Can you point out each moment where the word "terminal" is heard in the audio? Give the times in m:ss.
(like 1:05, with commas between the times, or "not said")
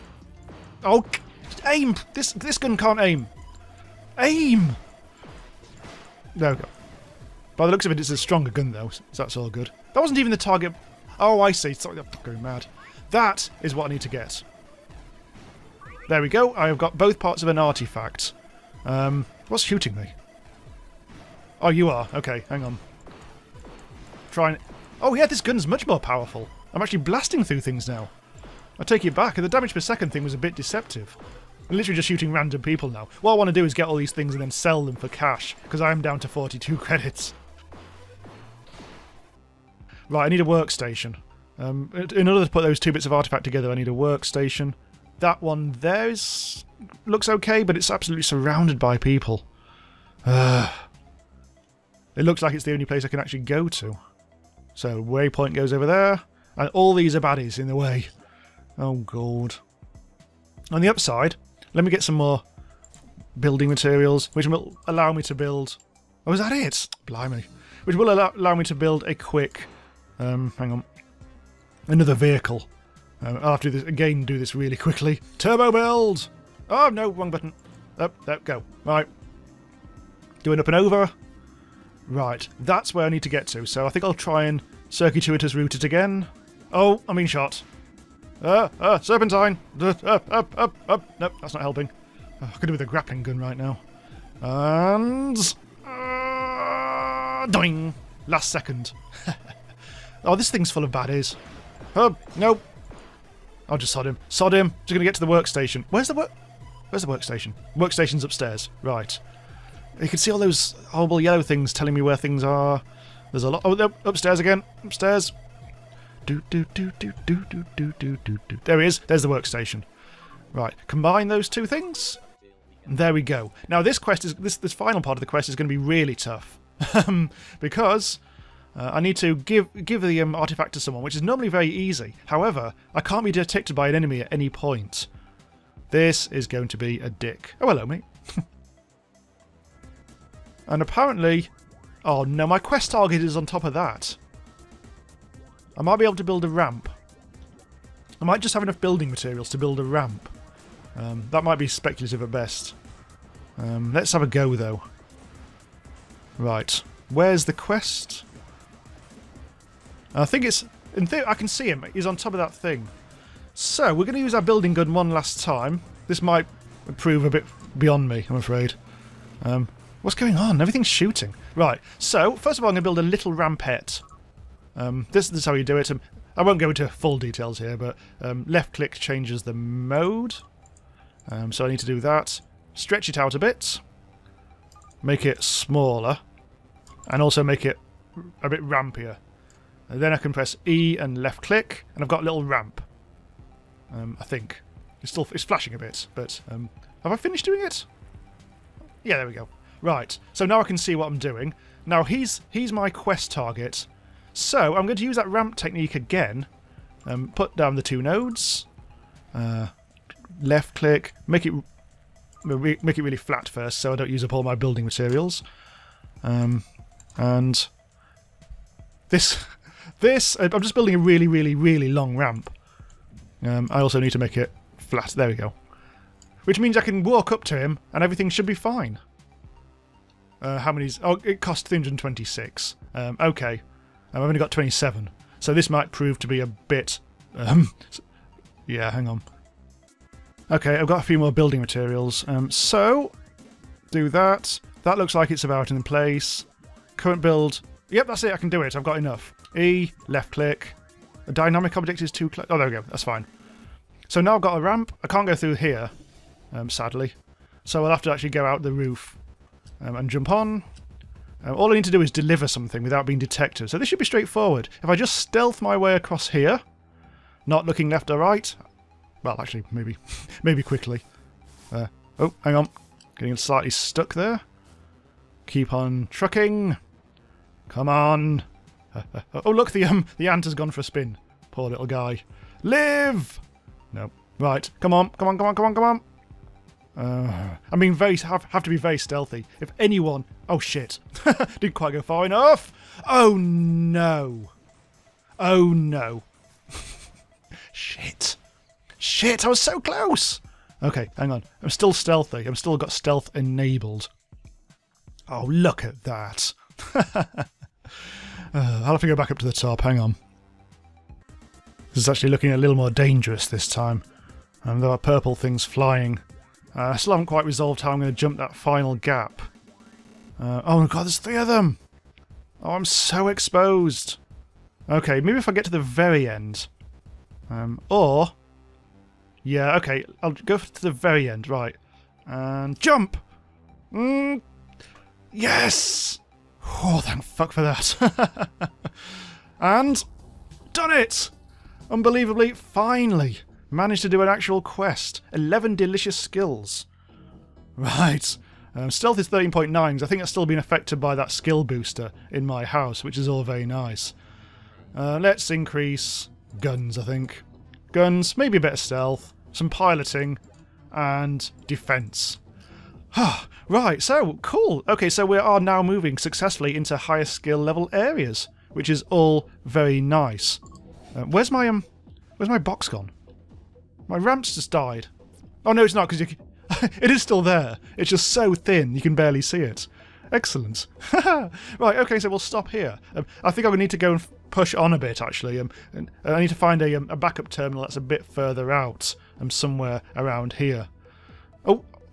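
6:27.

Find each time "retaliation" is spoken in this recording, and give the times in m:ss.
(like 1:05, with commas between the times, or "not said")
not said.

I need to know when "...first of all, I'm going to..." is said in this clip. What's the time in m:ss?
2:52.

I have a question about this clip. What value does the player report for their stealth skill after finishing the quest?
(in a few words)
13.9.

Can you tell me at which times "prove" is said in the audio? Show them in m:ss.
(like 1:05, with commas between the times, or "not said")
2:46, 3:55.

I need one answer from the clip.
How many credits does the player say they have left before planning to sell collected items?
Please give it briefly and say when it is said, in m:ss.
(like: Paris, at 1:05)
42, at 0:36.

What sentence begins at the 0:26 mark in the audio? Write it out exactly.
I'm actually blasting through things now.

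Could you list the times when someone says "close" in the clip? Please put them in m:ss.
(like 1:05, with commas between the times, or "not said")
4:12, 4:59.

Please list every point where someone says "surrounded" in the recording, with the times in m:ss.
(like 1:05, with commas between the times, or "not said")
0:48.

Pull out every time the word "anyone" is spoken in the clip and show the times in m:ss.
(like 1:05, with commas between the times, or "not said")
4:49.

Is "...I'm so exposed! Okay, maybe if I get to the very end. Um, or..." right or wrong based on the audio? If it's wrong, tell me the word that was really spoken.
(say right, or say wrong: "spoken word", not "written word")
right.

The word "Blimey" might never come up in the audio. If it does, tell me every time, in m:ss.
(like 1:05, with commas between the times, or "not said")
1:07.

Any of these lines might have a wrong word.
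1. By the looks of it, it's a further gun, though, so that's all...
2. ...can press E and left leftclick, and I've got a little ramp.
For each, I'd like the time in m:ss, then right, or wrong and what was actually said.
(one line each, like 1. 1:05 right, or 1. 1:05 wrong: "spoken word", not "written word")
1. 0:07 wrong: "stronger", not "further"
2. 3:10 wrong: "click", not "leftclick".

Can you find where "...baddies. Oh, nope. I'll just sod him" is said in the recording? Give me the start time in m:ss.
1:40.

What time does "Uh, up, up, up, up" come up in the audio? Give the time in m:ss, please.
1:29.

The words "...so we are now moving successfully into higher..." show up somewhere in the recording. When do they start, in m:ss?
6:05.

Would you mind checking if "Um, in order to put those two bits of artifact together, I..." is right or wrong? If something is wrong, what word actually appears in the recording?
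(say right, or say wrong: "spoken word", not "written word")
right.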